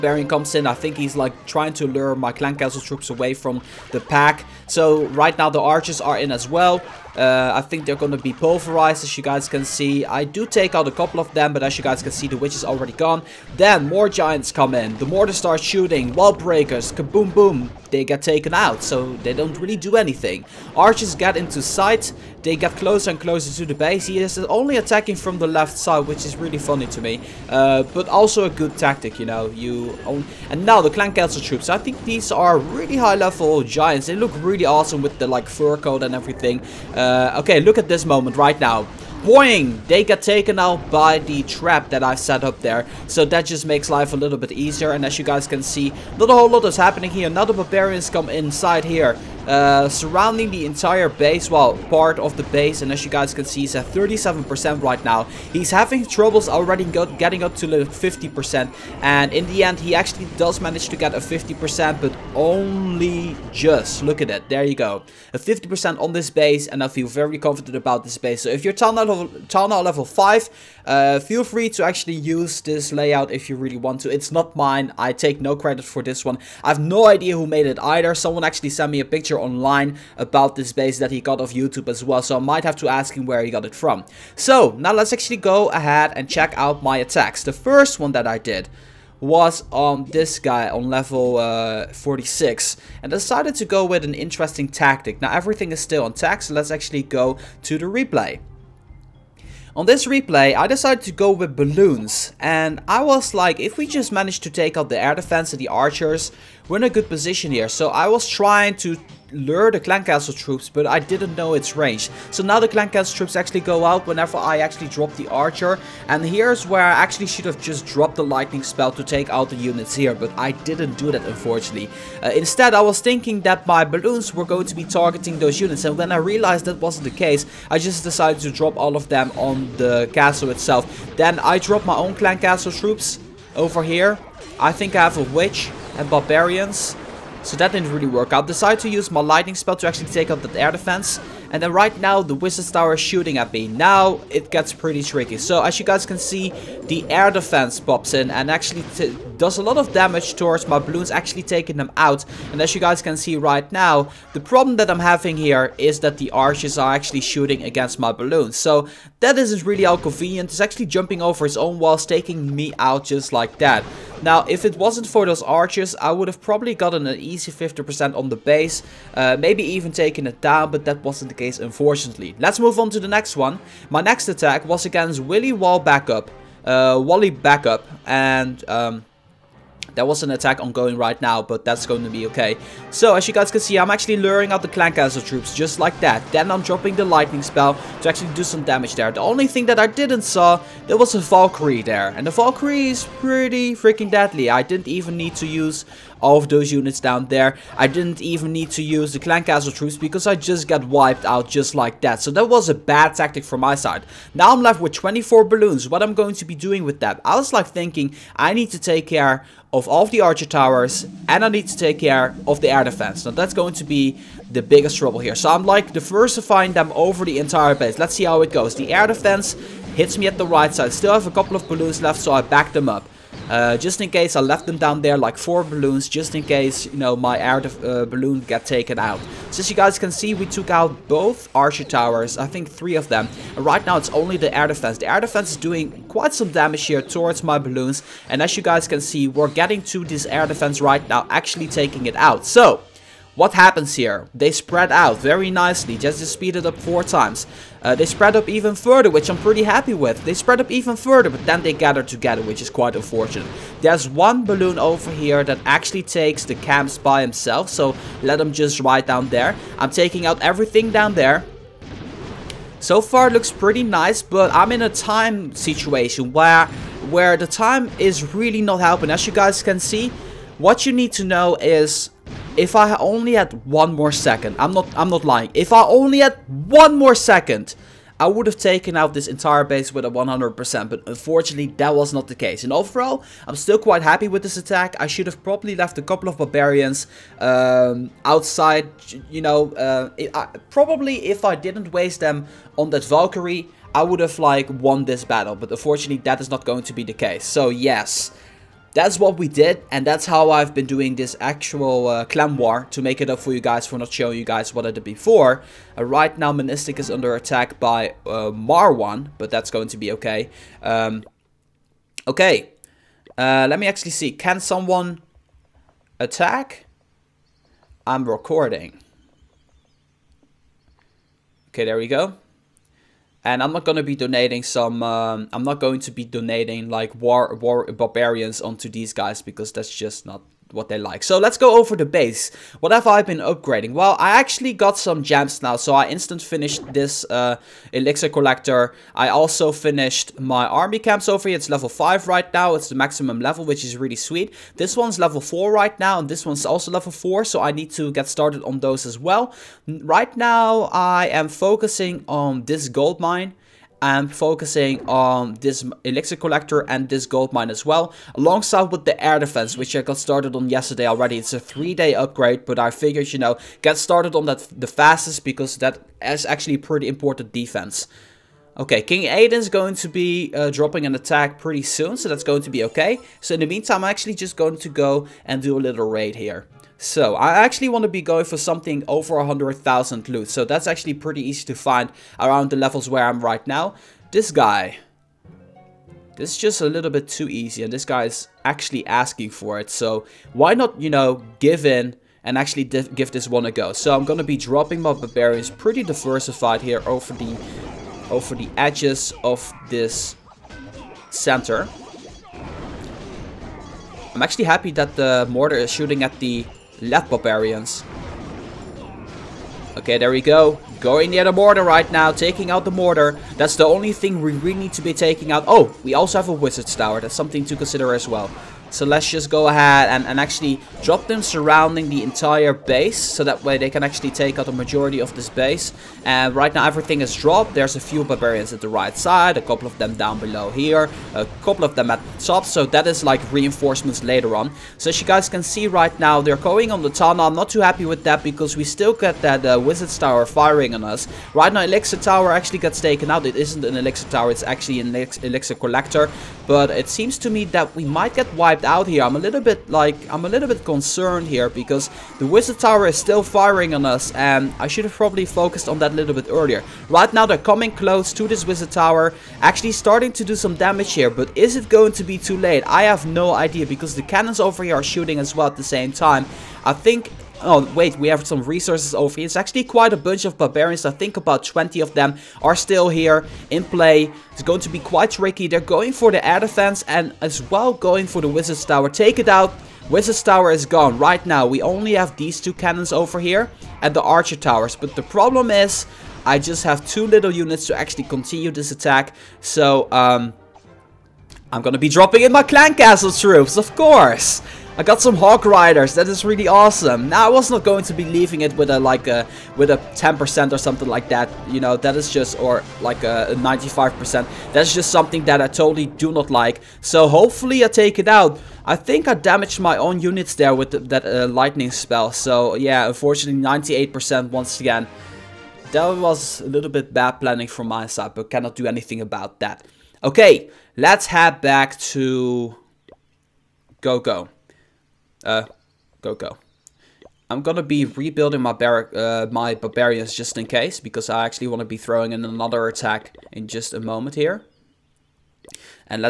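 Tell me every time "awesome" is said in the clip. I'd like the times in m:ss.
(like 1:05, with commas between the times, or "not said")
0:34, 8:16.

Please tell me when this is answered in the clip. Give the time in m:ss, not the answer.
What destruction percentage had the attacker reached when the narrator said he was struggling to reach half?
0:53.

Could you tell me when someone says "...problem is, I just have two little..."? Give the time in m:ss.
8:05.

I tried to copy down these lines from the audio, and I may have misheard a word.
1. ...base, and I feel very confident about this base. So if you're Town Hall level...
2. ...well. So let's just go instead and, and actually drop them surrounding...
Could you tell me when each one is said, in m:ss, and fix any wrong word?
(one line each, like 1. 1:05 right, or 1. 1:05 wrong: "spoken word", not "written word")
1. 1:06 right
2. 6:58 wrong: "ahead", not "instead".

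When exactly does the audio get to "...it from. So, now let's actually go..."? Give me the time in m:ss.
1:23.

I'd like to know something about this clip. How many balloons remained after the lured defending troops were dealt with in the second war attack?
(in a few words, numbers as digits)
24.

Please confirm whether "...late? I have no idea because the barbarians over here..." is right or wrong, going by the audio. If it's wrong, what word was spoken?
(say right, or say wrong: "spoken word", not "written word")
wrong: "cannons", not "barbarians".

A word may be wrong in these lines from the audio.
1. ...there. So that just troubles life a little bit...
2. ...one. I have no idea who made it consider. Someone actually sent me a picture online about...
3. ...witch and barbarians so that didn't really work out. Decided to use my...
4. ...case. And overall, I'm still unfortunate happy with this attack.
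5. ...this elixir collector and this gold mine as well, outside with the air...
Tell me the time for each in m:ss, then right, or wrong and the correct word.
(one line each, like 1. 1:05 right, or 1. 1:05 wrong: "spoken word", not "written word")
1. 0:42 wrong: "makes", not "troubles"
2. 1:16 wrong: "either", not "consider"
3. 2:15 right
4. 4:42 wrong: "quite", not "unfortunate"
5. 5:55 wrong: "alongside", not "outside".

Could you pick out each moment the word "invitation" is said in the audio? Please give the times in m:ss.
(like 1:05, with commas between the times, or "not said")
not said.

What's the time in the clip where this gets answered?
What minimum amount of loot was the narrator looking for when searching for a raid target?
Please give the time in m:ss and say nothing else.
6:19.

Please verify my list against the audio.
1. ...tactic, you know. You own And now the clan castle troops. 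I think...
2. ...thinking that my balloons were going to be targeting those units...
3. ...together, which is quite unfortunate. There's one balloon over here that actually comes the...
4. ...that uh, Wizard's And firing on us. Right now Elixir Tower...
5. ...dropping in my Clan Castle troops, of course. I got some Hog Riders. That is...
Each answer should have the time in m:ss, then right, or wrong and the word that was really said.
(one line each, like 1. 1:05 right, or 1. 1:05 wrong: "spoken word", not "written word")
1. 0:28 right
2. 2:03 right
3. 4:12 wrong: "takes", not "comes"
4. 7:19 wrong: "Tower", not "And"
5. 8:12 right.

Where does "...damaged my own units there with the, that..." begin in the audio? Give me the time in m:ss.
8:29.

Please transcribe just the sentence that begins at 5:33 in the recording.
Well, I actually got some gems now.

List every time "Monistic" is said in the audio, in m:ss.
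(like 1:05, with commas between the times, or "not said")
5:06.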